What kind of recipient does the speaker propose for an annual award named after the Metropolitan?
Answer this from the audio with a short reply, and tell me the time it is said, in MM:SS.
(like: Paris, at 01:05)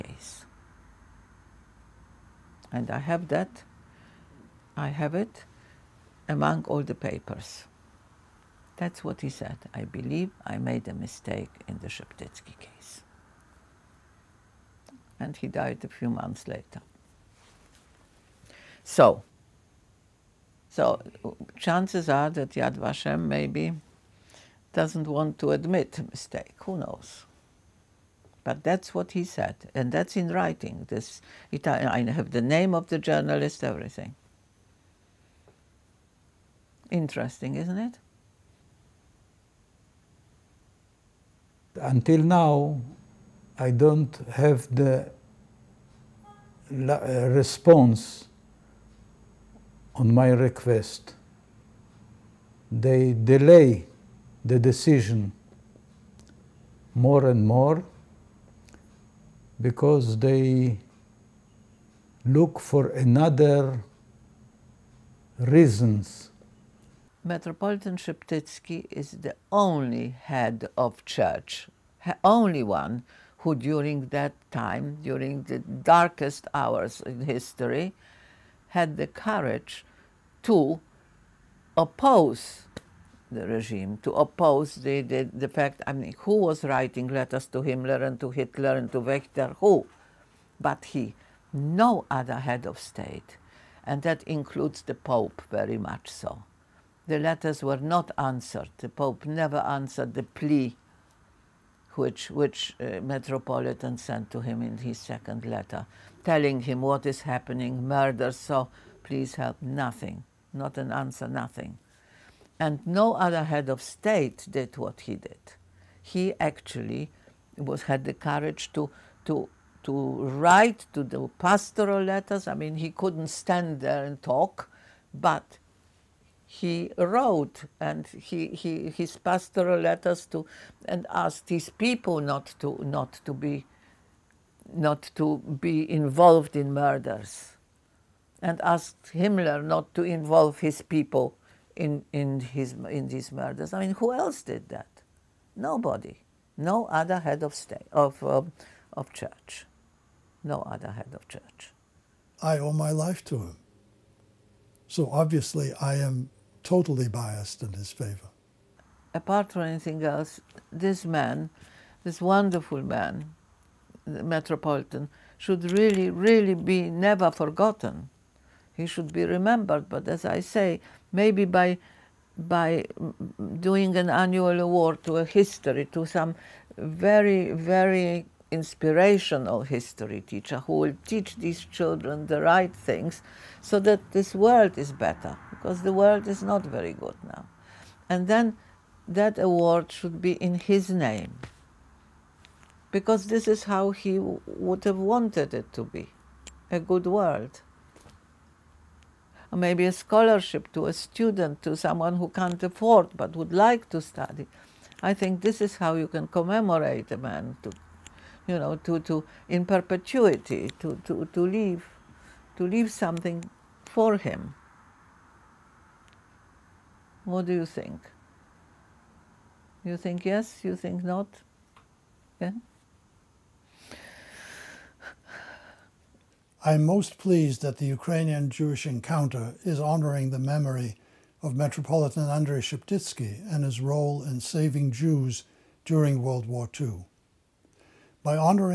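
history teacher, at 02:59.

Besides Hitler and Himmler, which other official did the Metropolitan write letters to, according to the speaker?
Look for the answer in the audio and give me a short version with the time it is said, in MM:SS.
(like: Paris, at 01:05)
Wächter, at 01:29.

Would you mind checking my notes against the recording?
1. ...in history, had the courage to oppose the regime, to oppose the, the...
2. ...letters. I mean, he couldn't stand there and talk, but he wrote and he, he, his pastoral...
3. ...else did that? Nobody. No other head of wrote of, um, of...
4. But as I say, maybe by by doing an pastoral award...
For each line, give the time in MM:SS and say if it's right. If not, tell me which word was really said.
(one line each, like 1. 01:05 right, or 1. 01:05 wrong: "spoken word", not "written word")
1. 01:17 right
2. 02:02 right
3. 02:24 wrong: "state", not "wrote"
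4. 02:49 wrong: "annual", not "pastoral".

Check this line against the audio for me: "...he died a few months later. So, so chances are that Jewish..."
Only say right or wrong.
wrong.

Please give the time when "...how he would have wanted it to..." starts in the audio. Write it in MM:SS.
03:13.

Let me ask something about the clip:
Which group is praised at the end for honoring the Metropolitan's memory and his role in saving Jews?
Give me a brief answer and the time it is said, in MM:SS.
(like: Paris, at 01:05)
Ukrainian Jewish Encounter, at 03:47.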